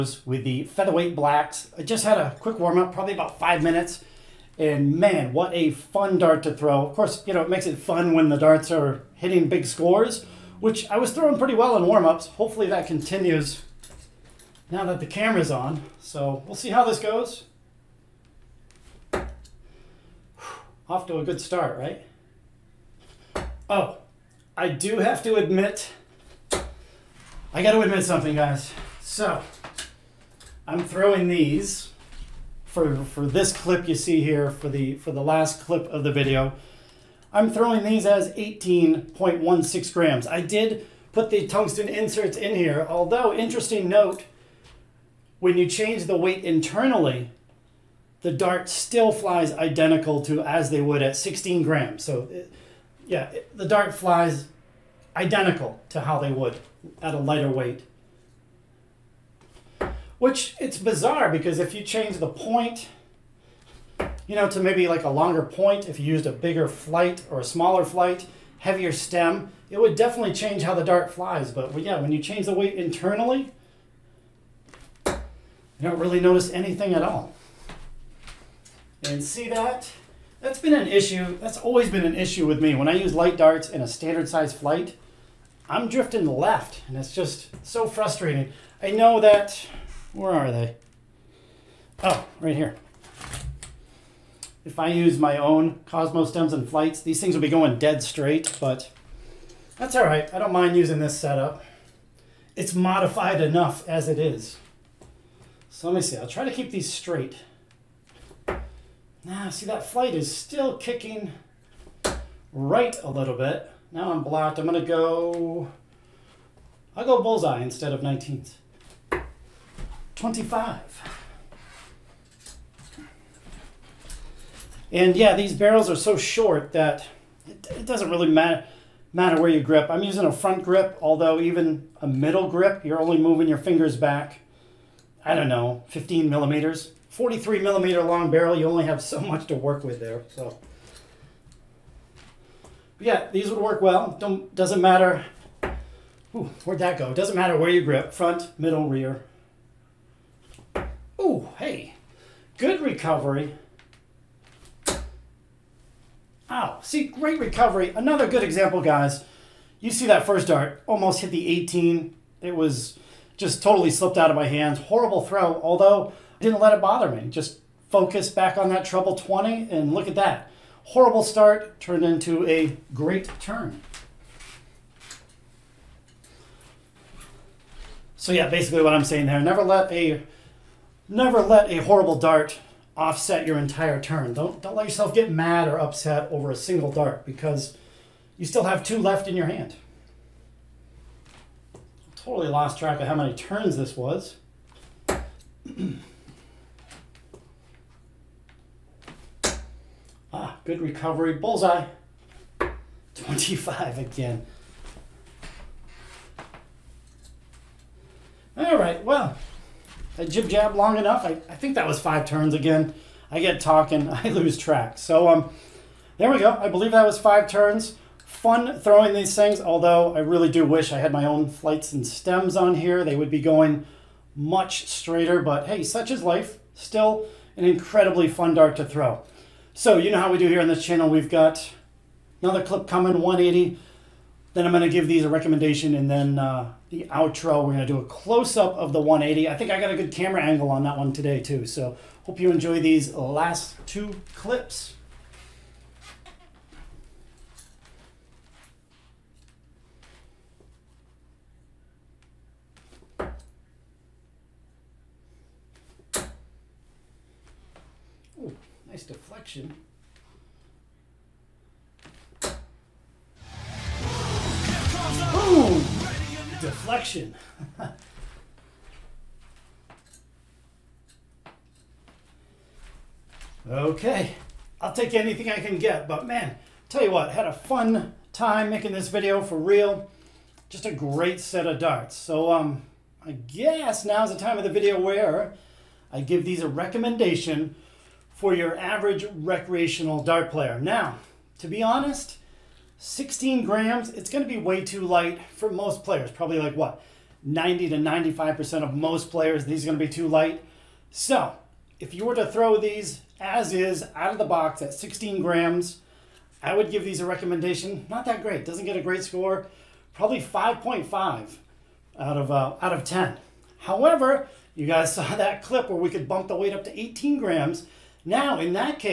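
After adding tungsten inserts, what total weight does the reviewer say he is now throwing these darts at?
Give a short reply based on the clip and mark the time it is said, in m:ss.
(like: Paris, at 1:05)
18.16 grams, at 0:38.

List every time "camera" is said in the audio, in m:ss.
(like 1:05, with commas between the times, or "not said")
0:15, 4:00.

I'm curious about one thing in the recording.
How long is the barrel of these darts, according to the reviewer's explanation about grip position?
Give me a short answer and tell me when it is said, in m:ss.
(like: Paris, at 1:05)
43 millimeters, at 2:17.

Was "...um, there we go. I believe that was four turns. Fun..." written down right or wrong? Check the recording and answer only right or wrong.
wrong.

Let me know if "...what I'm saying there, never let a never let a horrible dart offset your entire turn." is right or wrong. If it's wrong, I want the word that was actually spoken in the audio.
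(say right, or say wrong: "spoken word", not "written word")
right.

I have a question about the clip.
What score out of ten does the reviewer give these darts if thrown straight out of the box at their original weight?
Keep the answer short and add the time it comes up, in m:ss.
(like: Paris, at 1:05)
5.5, at 5:10.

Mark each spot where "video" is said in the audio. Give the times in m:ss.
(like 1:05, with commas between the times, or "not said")
0:36, 4:39, 4:44.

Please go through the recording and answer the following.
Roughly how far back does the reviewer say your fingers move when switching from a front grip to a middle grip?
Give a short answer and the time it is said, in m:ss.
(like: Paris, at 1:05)
15 millimeters, at 2:15.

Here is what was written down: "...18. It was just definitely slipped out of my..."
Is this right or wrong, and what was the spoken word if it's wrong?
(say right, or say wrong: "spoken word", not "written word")
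wrong: "totally", not "definitely".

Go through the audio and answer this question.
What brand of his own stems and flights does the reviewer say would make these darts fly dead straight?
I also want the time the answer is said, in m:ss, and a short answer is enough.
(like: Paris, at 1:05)
Cosmo, at 1:35.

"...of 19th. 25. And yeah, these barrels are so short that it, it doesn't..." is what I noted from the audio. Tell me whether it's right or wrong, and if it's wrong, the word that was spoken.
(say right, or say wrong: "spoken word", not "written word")
right.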